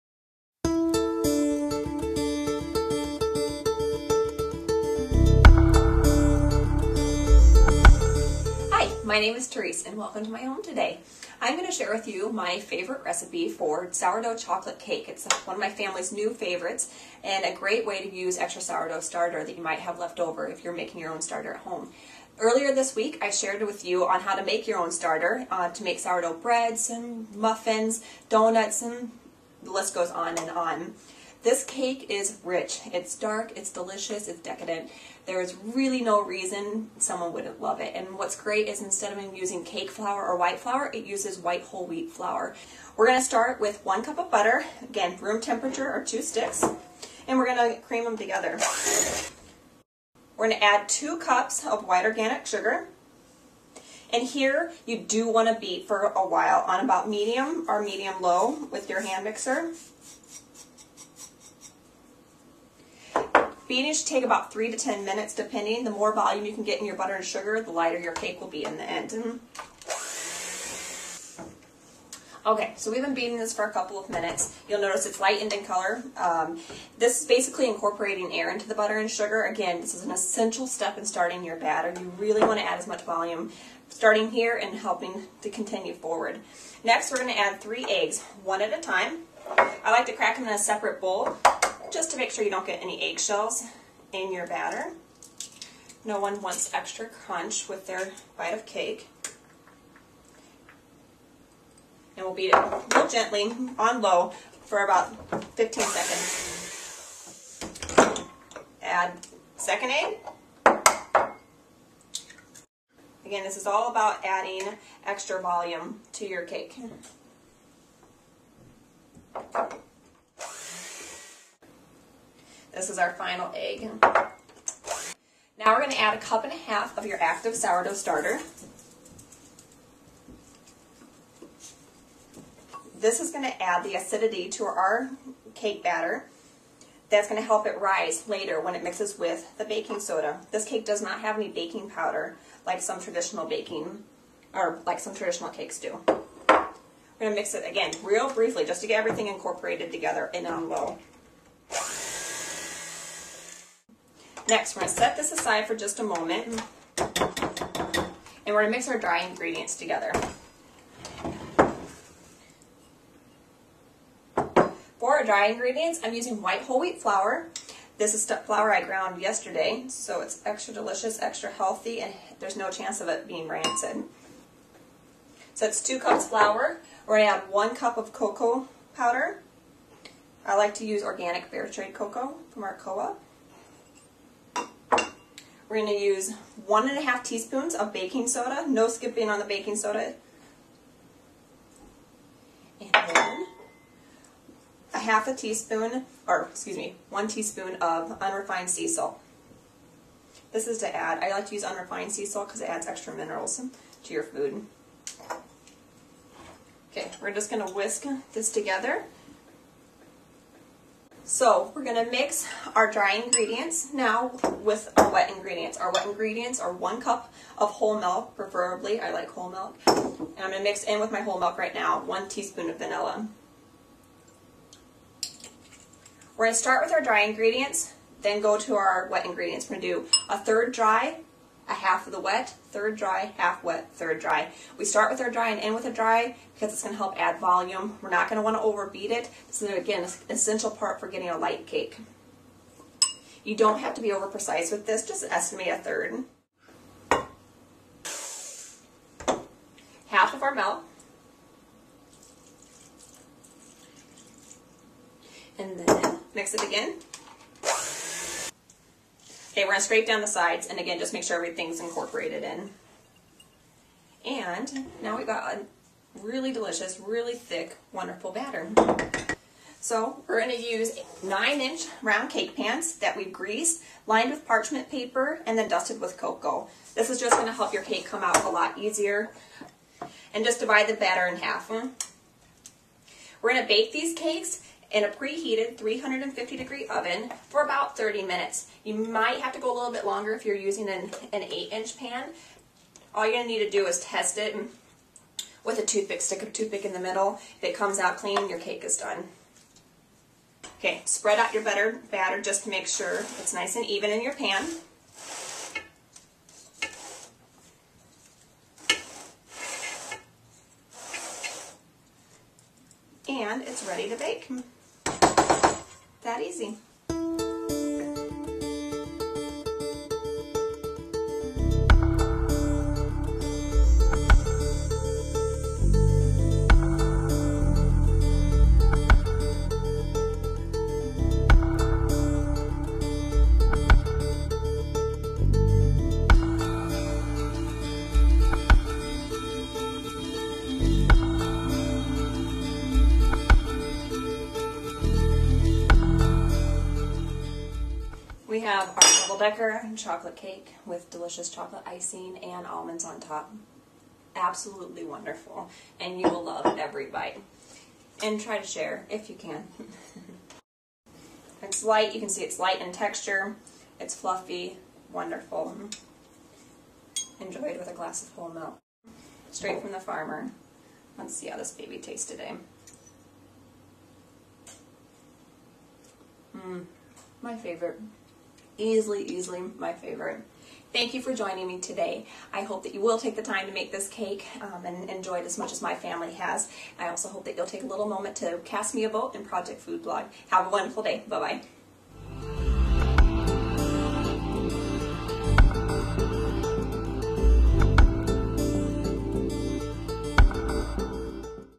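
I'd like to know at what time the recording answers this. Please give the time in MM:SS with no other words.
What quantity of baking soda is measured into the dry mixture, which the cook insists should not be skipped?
03:06.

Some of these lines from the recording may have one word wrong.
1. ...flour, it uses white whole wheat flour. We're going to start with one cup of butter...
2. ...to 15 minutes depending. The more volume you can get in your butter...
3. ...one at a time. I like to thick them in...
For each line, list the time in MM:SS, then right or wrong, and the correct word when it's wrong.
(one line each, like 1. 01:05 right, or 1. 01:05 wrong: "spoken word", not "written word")
1. 00:40 right
2. 01:04 wrong: "10", not "15"
3. 01:28 wrong: "crack", not "thick".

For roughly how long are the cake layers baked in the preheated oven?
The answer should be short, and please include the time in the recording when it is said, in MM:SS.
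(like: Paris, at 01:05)
30 minutes, at 04:47.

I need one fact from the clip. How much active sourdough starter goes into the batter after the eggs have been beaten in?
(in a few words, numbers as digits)
1.5 cups.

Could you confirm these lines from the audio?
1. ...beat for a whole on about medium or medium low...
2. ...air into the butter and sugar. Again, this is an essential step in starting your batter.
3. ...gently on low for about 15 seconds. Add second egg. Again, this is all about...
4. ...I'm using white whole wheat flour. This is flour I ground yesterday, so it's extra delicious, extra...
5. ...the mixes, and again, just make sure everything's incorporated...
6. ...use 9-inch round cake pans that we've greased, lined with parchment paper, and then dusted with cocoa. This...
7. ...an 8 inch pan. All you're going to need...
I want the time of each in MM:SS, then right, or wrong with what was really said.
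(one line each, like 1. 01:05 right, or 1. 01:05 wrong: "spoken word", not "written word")
1. 00:55 wrong: "while", not "whole"
2. 01:18 right
3. 01:43 right
4. 02:46 right
5. 04:20 wrong: "sides", not "mixes"
6. 04:30 right
7. 04:51 right.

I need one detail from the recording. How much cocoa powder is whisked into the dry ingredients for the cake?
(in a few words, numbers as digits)
1 cup.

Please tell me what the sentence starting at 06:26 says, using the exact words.
I also hope that you'll take a little moment to cast me a vote in Project Food Blog.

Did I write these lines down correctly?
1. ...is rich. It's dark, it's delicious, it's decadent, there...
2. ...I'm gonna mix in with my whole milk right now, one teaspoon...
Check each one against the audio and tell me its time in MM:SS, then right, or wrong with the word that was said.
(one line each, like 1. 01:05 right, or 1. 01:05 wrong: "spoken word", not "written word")
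1. 00:32 right
2. 03:40 right.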